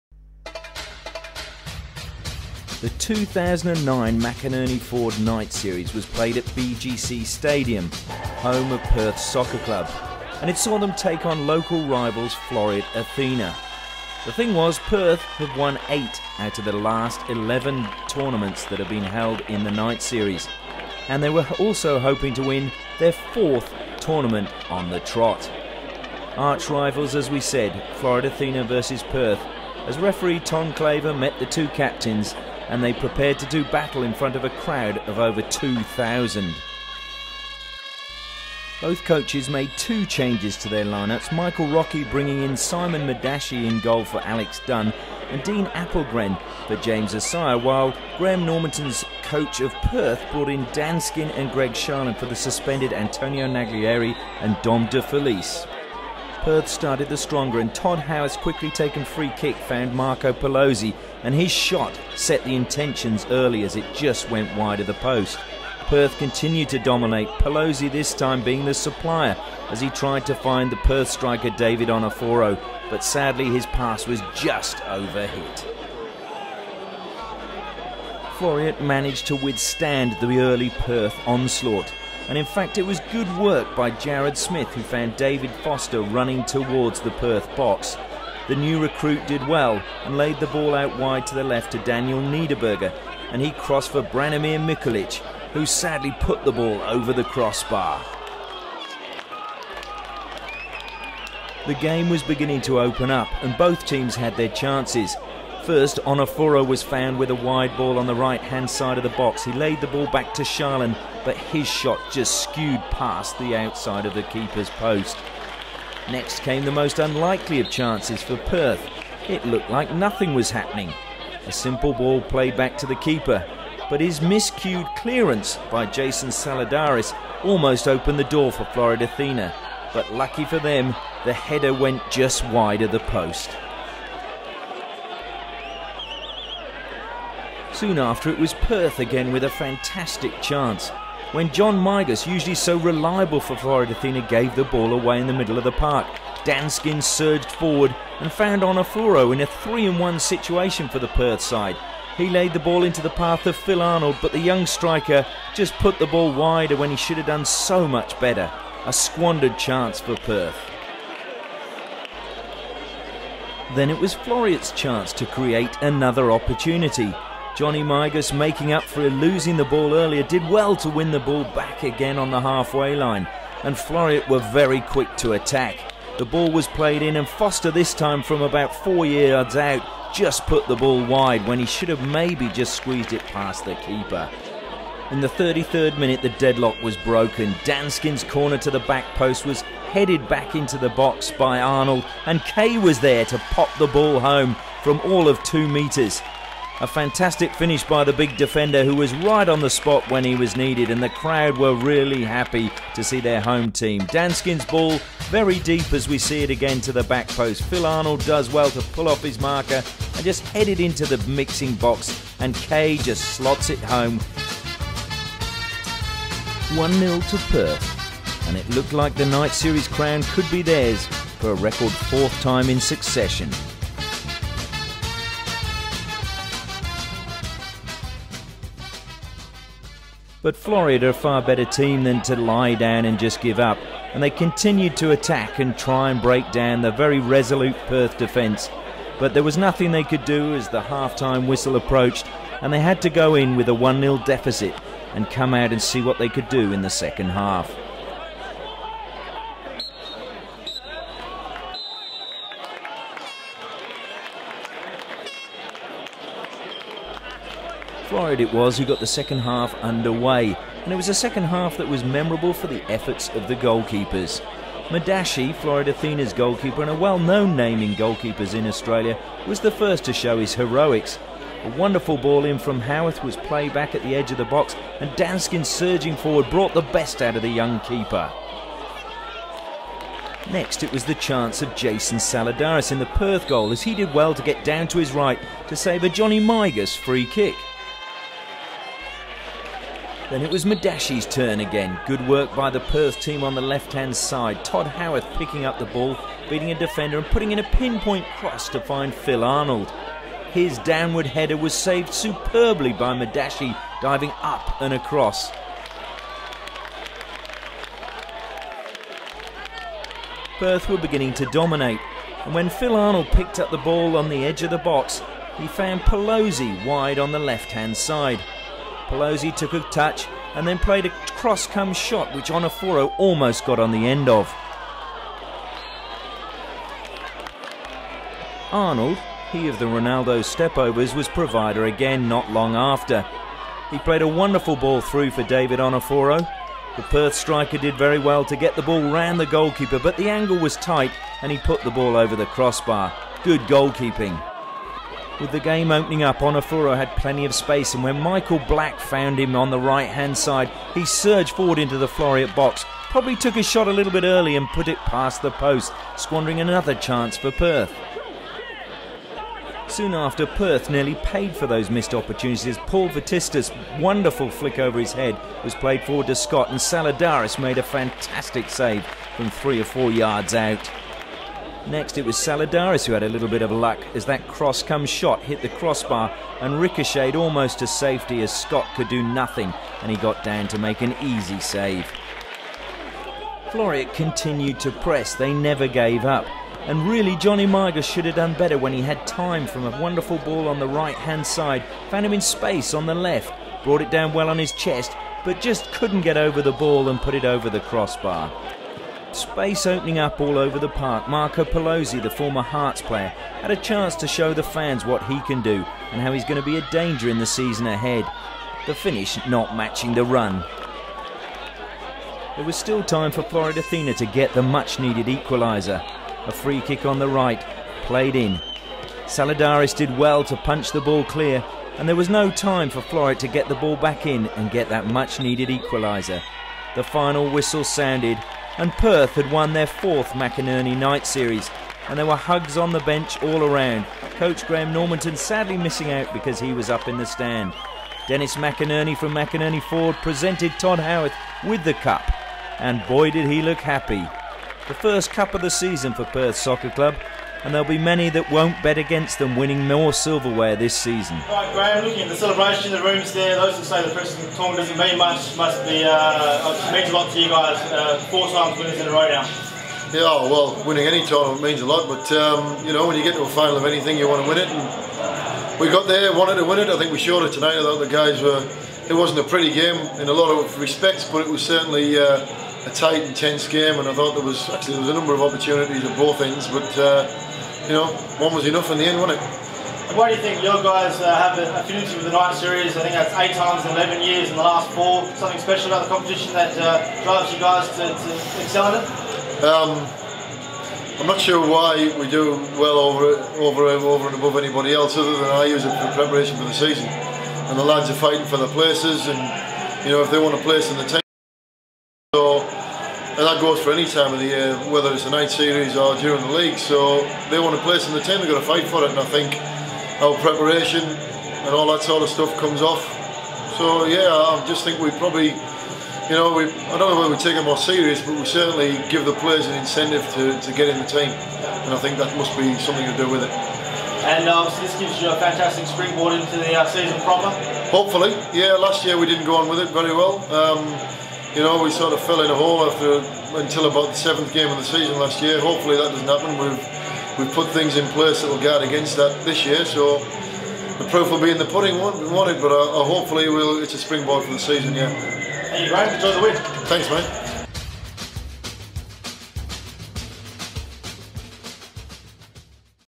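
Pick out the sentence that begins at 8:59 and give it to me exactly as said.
So the proof will be in the pudding, won't, won't it?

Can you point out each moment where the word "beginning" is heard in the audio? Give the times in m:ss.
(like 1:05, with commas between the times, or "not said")
1:42, 5:10.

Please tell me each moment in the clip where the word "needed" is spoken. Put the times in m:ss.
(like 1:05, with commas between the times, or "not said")
3:20, 6:54, 7:05.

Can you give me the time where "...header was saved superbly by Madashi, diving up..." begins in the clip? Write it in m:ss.
5:01.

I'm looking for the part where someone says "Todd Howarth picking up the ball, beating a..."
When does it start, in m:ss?
4:54.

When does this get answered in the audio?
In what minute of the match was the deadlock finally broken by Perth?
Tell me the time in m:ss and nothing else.
3:05.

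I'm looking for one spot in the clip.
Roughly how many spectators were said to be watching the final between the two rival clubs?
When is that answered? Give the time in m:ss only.
0:35.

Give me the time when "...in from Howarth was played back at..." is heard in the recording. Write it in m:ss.
4:32.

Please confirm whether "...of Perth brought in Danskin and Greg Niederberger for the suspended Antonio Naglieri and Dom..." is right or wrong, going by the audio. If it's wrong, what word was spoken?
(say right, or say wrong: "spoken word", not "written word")
wrong: "Sharland", not "Niederberger".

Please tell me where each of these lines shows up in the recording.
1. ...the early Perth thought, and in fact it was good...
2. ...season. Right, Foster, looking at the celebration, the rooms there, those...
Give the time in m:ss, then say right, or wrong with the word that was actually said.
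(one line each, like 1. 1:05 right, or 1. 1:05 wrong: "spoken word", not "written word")
1. 1:20 wrong: "onslaught", not "thought"
2. 7:30 wrong: "Graham", not "Foster".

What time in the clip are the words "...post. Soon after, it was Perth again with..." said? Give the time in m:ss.
2:13.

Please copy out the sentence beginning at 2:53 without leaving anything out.
And Floreat were very quick to attack.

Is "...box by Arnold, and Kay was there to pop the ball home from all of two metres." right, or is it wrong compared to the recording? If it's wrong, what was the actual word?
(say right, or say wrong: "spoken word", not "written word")
right.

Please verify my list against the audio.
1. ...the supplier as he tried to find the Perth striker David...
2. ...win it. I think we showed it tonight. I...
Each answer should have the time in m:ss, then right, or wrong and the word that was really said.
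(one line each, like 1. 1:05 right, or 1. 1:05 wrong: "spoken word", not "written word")
1. 1:08 right
2. 7:46 right.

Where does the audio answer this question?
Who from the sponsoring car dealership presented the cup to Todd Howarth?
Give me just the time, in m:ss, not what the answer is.
7:18.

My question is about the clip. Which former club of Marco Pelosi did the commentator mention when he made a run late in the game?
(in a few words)
Hearts.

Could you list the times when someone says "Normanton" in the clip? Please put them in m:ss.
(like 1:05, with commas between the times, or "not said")
0:48, 7:14.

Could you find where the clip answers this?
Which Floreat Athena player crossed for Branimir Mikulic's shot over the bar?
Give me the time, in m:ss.
1:31.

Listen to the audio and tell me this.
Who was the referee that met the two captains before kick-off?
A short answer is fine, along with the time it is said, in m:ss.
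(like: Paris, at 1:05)
Tom Claver, at 0:30.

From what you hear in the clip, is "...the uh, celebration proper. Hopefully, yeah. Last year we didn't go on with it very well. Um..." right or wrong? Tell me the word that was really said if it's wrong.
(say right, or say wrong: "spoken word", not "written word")
wrong: "season", not "celebration".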